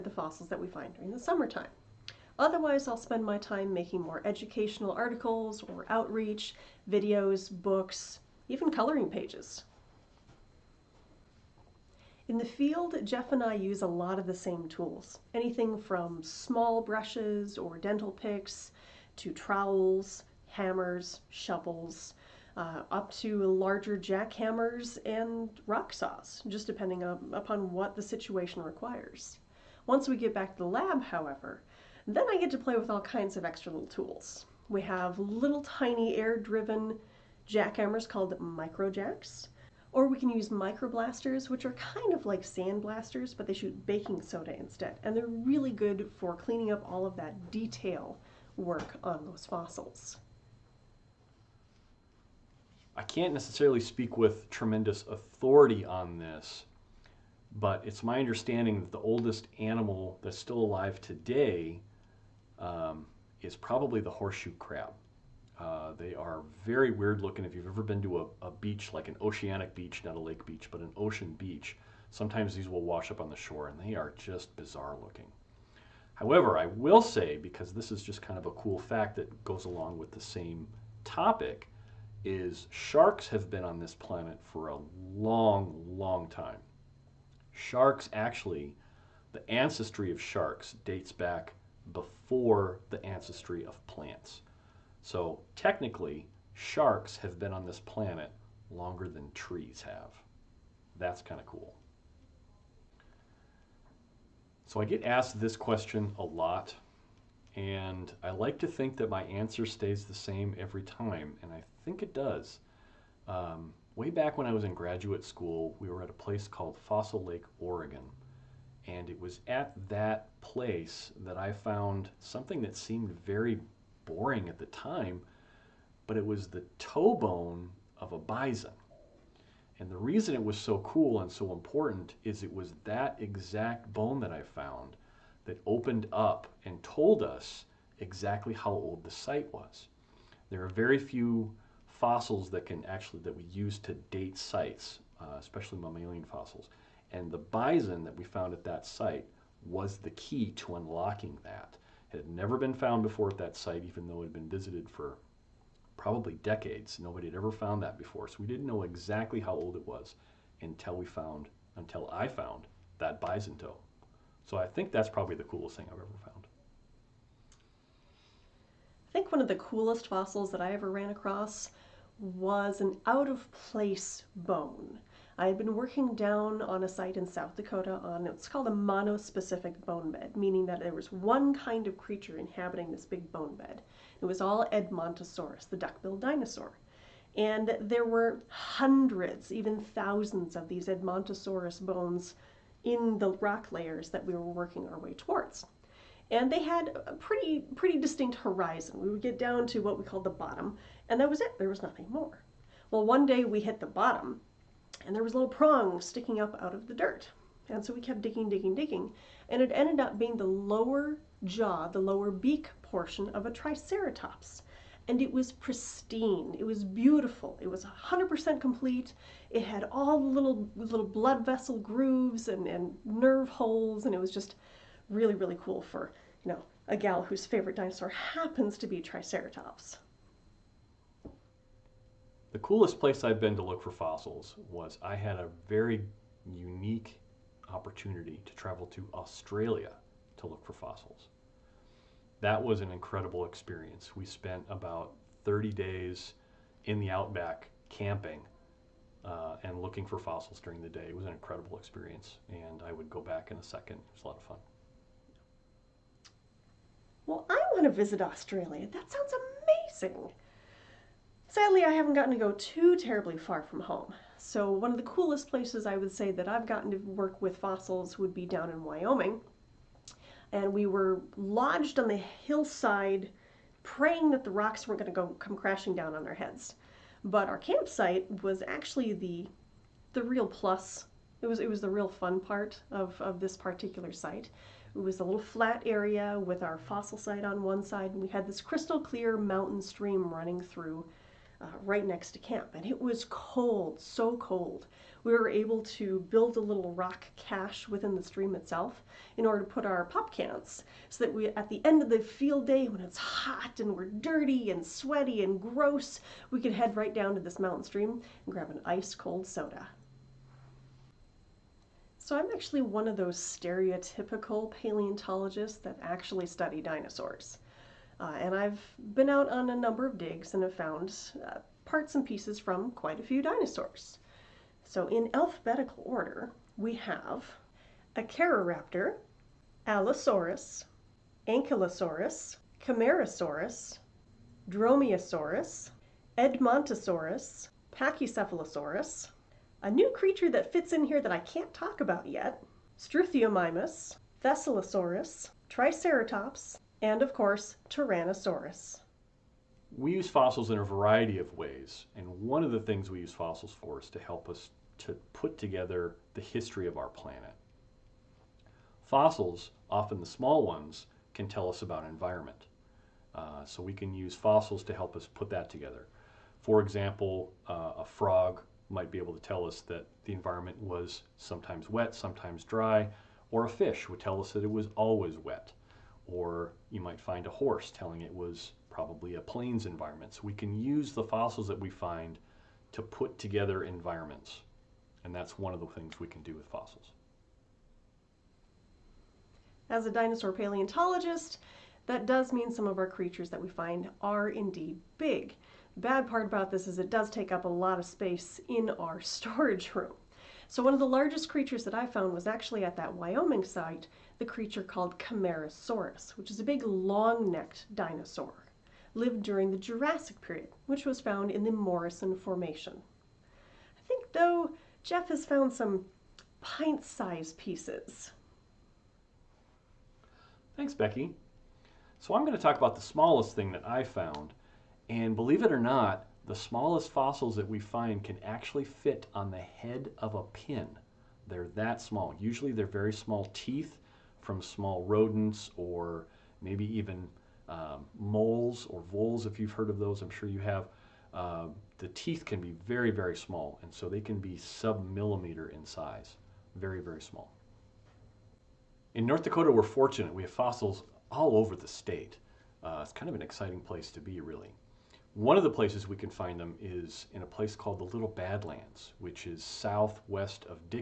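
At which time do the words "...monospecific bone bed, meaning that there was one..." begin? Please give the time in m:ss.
2:58.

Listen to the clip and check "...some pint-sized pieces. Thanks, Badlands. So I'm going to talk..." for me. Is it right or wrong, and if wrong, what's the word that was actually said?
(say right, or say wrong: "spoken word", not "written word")
wrong: "Becky", not "Badlands".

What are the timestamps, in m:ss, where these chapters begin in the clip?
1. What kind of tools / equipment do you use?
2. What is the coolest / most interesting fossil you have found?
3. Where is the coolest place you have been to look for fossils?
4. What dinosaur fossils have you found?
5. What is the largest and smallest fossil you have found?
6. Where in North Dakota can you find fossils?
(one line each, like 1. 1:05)
1. 0:10
2. 1:42
3. 3:50
4. 5:10
5. 6:27
6. 7:27.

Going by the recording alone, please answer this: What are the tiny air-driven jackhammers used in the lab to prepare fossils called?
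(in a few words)
microjacks.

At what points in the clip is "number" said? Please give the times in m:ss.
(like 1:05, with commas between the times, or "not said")
5:19.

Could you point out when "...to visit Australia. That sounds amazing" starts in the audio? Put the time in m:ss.
4:17.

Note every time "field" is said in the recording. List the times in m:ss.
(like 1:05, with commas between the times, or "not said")
0:12, 5:02.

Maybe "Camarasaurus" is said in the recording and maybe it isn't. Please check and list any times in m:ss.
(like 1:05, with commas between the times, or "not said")
5:32, 6:45.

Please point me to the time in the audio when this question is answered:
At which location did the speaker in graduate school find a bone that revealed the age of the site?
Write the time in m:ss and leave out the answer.
1:56.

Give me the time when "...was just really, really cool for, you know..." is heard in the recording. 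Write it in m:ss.
3:44.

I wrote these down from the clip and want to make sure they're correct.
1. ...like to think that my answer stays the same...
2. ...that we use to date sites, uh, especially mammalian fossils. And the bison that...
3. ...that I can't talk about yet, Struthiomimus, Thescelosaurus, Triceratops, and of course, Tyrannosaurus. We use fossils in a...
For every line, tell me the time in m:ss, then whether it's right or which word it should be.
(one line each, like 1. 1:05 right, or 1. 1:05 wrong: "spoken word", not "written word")
1. 1:48 right
2. 2:23 right
3. 5:41 right.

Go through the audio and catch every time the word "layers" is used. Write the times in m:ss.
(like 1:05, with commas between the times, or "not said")
3:13.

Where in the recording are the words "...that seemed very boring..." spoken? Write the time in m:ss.
2:02.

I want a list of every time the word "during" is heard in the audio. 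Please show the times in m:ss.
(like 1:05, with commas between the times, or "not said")
0:00, 4:10, 6:49.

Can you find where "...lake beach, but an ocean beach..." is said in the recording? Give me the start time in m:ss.
1:10.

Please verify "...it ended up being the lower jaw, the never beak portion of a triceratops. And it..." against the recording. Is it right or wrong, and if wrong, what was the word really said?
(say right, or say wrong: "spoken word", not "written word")
wrong: "lower", not "never".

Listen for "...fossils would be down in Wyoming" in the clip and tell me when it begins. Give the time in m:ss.
4:27.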